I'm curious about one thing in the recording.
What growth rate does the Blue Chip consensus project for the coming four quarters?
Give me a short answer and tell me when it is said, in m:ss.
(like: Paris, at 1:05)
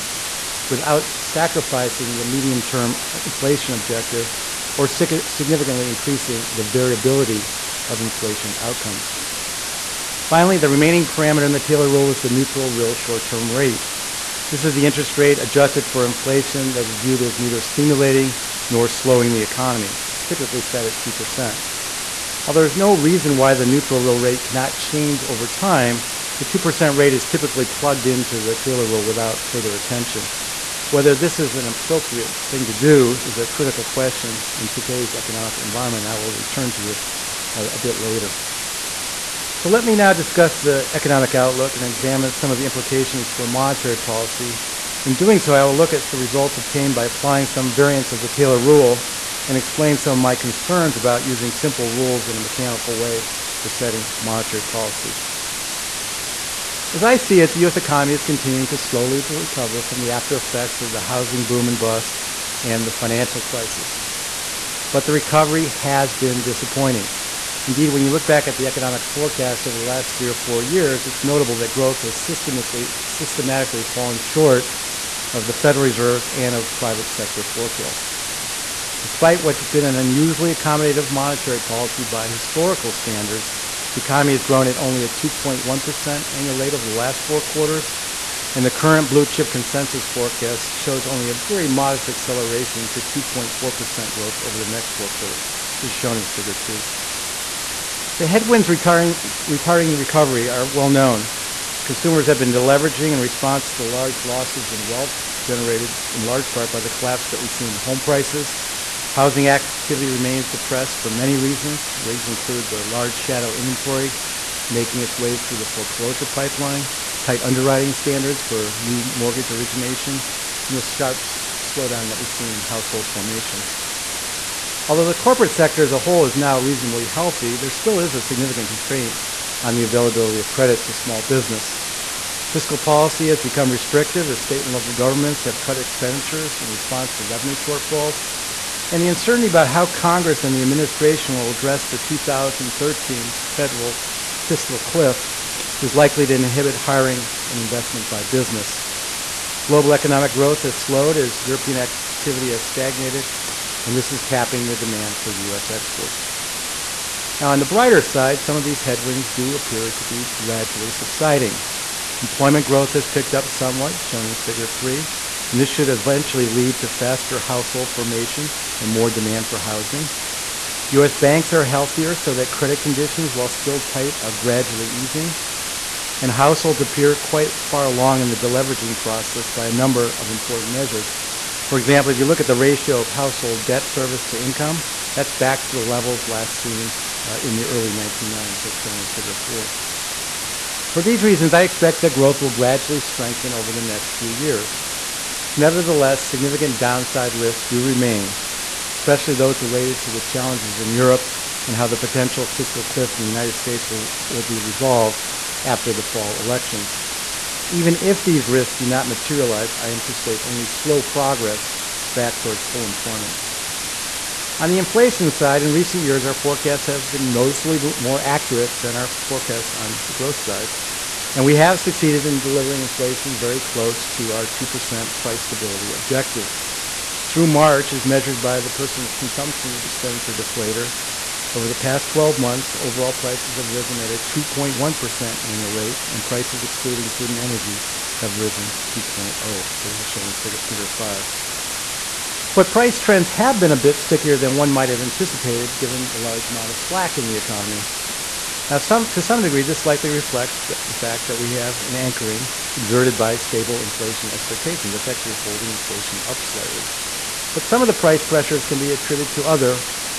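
2.4%, at 1:33.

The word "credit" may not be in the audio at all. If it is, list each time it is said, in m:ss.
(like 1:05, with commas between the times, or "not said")
2:10, 2:52.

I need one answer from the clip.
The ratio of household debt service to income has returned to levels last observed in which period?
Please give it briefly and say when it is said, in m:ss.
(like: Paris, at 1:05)
early 1990s, at 3:07.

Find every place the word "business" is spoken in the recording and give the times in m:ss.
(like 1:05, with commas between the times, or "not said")
2:11, 2:28.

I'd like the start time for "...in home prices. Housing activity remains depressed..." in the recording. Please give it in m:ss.
1:47.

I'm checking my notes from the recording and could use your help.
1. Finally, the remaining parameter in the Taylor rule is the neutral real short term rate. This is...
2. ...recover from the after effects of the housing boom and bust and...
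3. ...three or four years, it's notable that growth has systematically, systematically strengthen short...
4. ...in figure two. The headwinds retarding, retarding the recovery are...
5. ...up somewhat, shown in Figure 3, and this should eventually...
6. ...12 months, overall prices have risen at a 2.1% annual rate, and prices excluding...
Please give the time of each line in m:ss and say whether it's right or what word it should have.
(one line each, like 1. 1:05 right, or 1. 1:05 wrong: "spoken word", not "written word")
1. 0:10 right
2. 0:59 right
3. 1:10 wrong: "fallen", not "strengthen"
4. 1:36 right
5. 2:43 right
6. 3:52 right.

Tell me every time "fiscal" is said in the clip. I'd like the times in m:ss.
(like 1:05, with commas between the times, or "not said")
2:12, 2:24, 3:22.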